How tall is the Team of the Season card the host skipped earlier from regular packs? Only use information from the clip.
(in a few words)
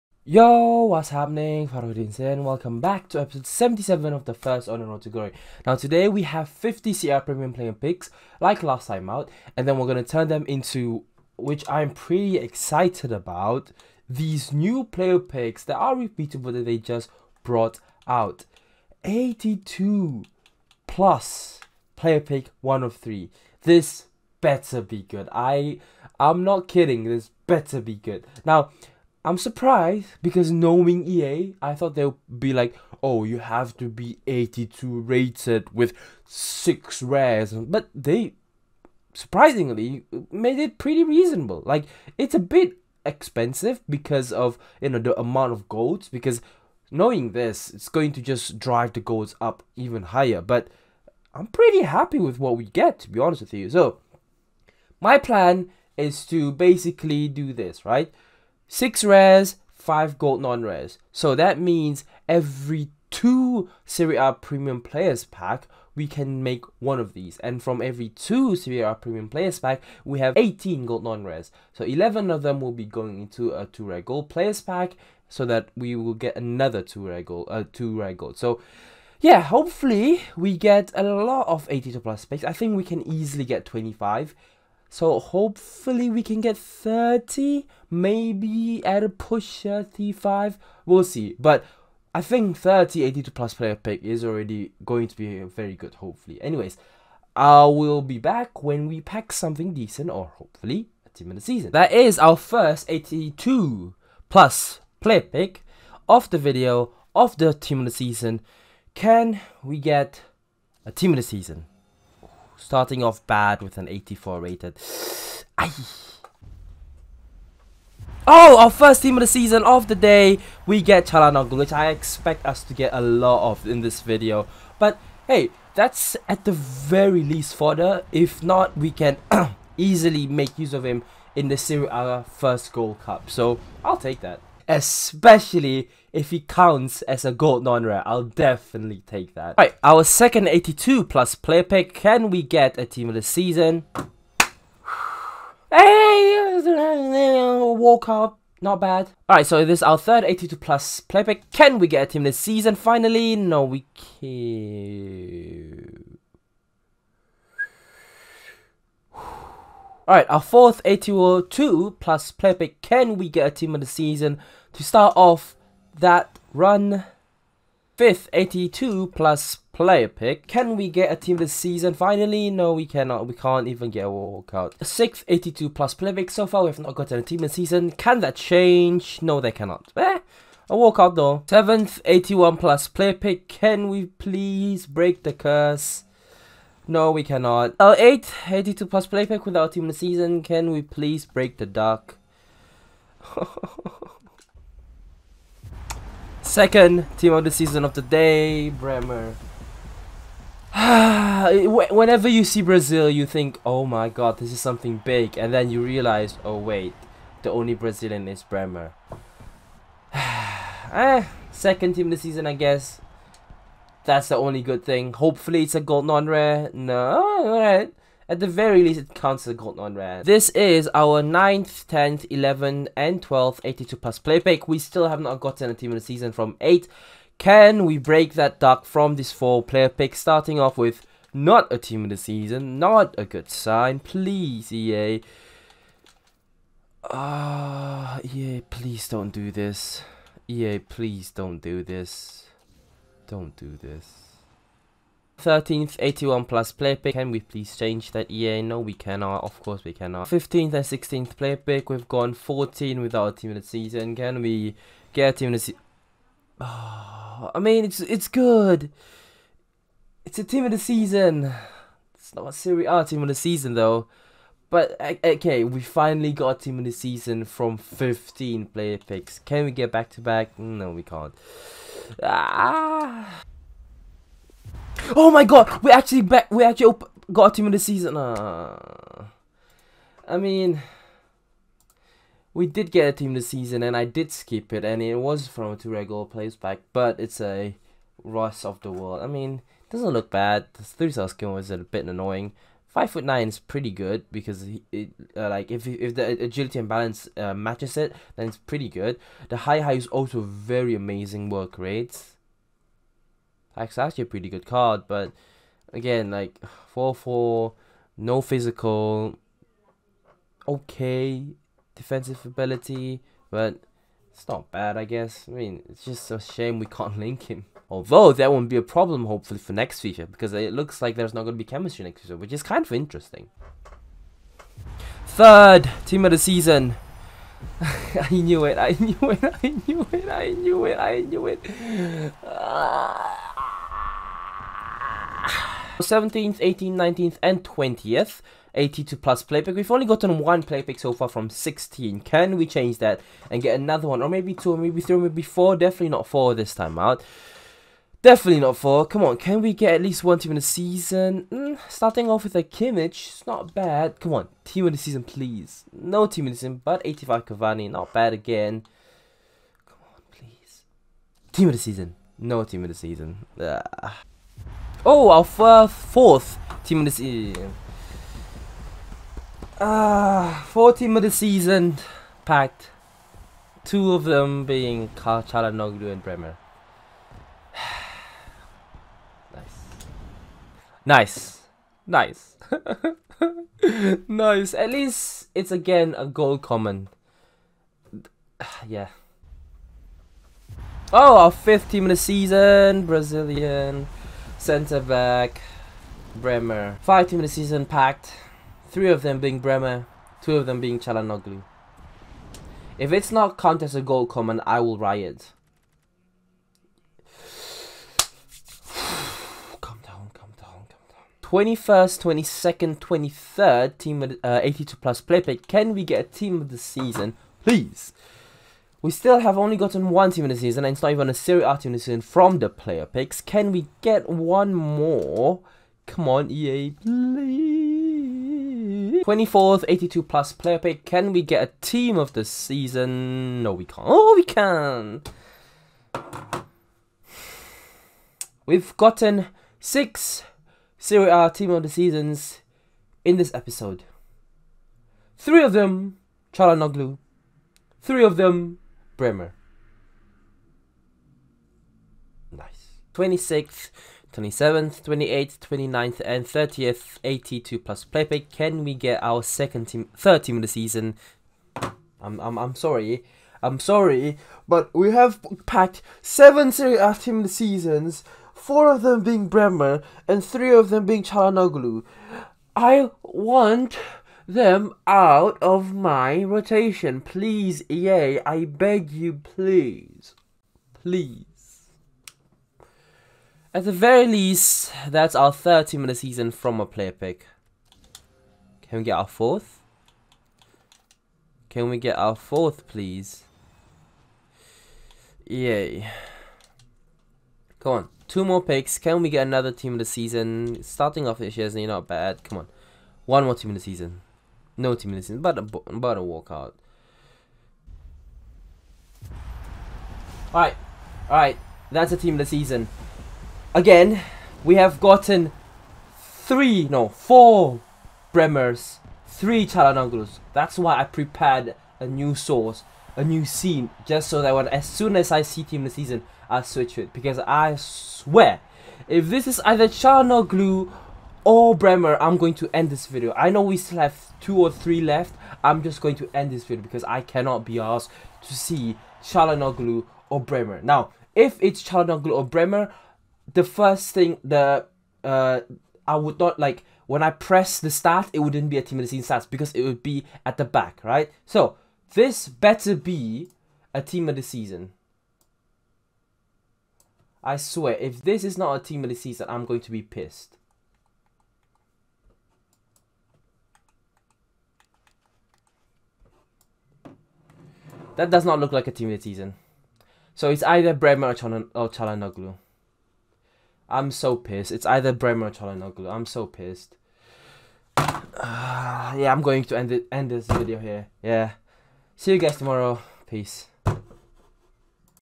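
Five foot nine.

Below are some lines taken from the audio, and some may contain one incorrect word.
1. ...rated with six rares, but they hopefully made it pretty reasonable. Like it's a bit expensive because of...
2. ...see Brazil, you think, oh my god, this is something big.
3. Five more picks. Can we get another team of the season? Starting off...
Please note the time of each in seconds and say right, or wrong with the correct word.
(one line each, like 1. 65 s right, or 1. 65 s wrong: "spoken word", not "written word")
1. 35 s wrong: "surprisingly", not "hopefully"
2. 202 s right
3. 498 s wrong: "Two", not "Five".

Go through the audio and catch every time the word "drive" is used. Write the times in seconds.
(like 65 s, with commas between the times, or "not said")
48 s.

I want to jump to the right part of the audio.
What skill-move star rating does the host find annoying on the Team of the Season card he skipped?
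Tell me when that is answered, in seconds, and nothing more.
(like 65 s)
290 s.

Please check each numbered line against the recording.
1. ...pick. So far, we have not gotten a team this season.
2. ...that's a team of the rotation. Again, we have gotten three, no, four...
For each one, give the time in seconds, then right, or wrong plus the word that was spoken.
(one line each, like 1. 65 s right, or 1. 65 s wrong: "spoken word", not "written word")
1. 176 s right
2. 511 s wrong: "season", not "rotation".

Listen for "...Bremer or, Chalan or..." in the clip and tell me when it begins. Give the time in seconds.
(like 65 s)
570 s.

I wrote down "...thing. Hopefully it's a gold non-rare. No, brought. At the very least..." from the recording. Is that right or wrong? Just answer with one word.
wrong.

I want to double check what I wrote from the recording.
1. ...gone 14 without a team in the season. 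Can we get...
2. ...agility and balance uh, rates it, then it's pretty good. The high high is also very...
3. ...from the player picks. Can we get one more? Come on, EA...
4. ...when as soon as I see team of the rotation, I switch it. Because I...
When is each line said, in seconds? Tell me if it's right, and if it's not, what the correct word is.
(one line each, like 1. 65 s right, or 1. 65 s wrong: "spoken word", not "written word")
1. 252 s right
2. 296 s wrong: "matches", not "rates"
3. 422 s right
4. 524 s wrong: "season", not "rotation".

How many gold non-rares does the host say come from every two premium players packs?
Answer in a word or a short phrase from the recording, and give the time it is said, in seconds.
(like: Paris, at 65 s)
18, at 70 s.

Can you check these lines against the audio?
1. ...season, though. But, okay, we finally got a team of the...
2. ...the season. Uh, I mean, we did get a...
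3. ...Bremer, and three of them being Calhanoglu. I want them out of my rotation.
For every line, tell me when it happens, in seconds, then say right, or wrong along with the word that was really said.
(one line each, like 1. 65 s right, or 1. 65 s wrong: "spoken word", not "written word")
1. 263 s right
2. 277 s right
3. 469 s right.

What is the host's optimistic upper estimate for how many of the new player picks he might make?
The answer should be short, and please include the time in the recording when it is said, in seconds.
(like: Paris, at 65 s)
35, at 89 s.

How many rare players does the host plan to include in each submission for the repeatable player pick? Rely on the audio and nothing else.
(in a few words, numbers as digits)
6.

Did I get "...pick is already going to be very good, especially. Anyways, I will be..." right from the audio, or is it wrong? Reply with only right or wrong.
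wrong.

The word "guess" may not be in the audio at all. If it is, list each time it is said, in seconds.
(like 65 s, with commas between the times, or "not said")
212 s, 315 s.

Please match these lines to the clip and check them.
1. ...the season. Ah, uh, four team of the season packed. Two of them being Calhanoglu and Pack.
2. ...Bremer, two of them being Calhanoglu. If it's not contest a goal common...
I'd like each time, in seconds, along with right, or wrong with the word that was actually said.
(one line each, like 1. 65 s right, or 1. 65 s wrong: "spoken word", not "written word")
1. 367 s wrong: "Bremer", not "Pack"
2. 399 s right.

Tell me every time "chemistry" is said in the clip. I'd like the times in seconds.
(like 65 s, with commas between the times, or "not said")
321 s.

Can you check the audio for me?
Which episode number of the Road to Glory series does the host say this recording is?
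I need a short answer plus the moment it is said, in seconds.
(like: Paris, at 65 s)
77, at 3 s.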